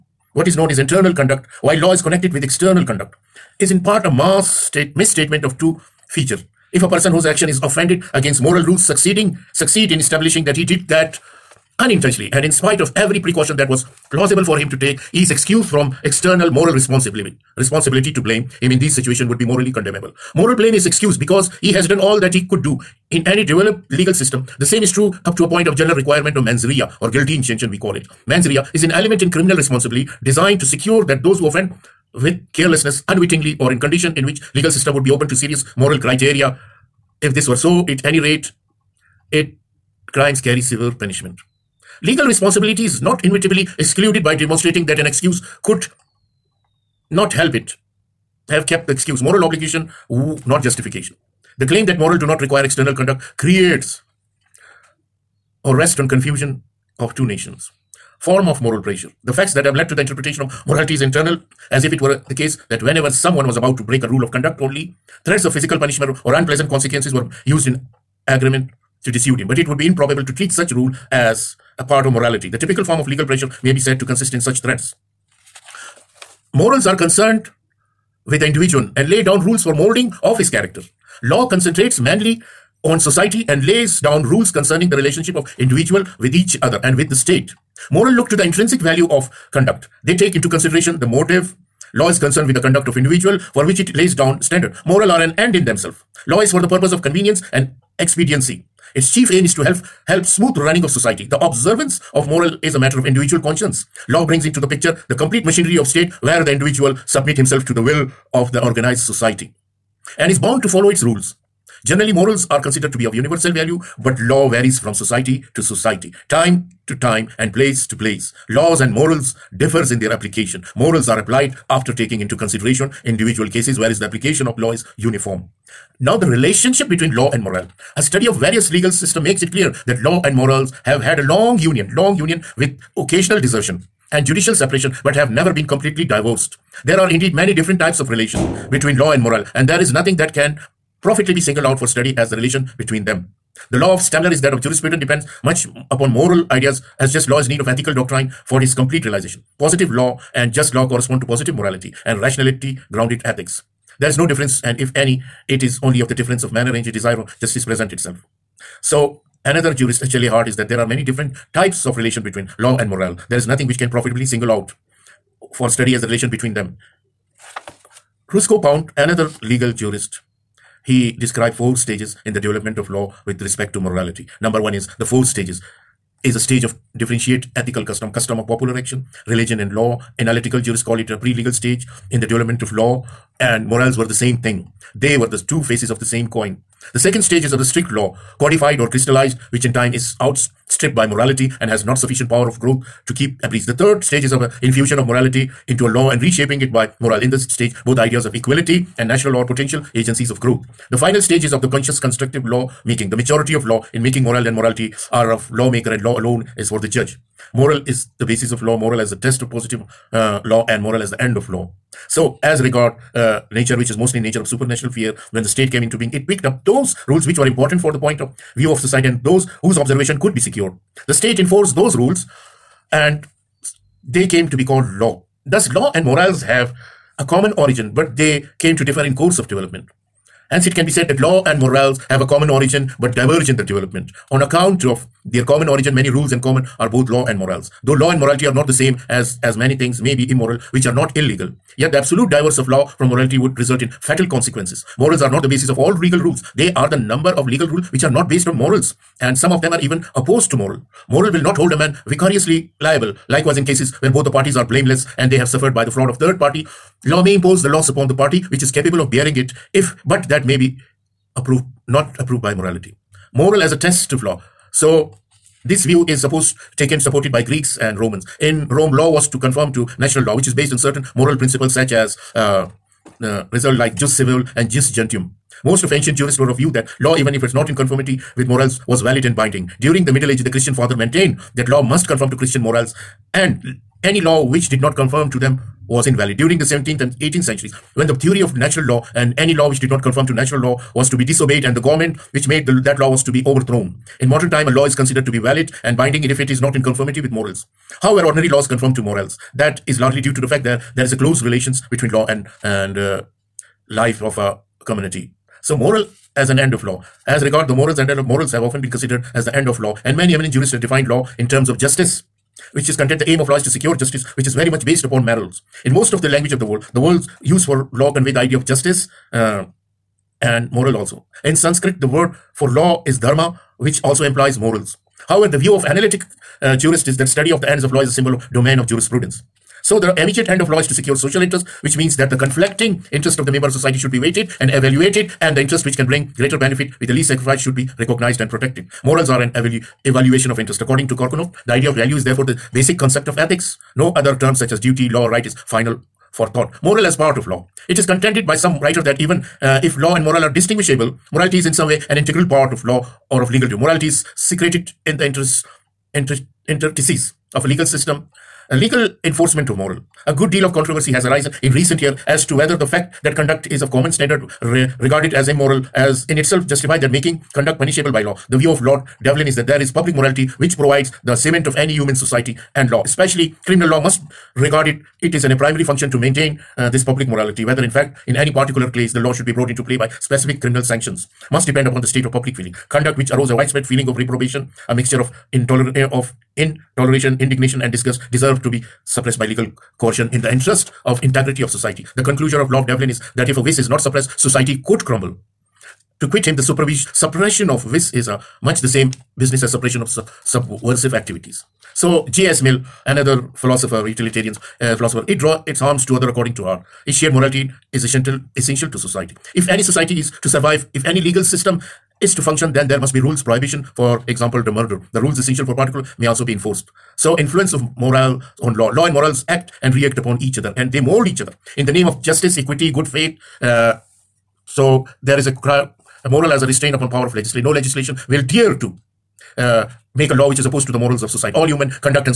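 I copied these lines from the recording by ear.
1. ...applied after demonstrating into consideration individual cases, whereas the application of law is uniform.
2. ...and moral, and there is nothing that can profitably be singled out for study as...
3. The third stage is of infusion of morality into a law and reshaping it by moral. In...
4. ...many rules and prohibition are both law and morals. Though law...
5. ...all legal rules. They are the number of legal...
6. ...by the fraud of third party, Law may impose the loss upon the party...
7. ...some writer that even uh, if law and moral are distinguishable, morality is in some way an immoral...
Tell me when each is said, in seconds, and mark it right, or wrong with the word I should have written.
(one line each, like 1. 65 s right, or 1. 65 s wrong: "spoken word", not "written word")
1. 121 s wrong: "taking", not "demonstrating"
2. 139 s right
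3. 193 s right
4. 235 s wrong: "common", not "prohibition"
5. 245 s right
6. 255 s right
7. 348 s wrong: "integral", not "immoral".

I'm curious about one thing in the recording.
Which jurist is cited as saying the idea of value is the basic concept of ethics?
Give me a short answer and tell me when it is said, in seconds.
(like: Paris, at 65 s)
Korkunov, at 341 s.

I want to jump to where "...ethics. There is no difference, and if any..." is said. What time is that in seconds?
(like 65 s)
153 s.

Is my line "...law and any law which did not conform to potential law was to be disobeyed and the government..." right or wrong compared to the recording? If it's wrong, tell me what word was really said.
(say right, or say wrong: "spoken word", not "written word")
wrong: "natural", not "potential".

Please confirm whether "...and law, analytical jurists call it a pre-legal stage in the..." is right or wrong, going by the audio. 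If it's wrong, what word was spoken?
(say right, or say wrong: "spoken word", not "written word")
right.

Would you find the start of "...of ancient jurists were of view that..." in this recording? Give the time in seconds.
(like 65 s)
275 s.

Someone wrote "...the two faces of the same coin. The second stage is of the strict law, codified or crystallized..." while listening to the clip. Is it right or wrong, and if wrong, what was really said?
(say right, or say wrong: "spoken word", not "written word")
right.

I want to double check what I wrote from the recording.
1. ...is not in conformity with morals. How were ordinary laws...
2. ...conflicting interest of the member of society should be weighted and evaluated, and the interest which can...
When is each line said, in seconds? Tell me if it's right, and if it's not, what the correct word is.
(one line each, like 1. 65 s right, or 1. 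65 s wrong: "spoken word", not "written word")
1. 296 s right
2. 332 s right.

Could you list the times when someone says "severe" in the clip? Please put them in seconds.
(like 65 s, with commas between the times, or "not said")
40 s.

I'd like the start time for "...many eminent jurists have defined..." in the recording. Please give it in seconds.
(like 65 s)
310 s.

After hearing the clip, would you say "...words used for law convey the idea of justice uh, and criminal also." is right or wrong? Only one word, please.
wrong.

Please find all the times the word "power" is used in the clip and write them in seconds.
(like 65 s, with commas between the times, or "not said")
192 s, 427 s.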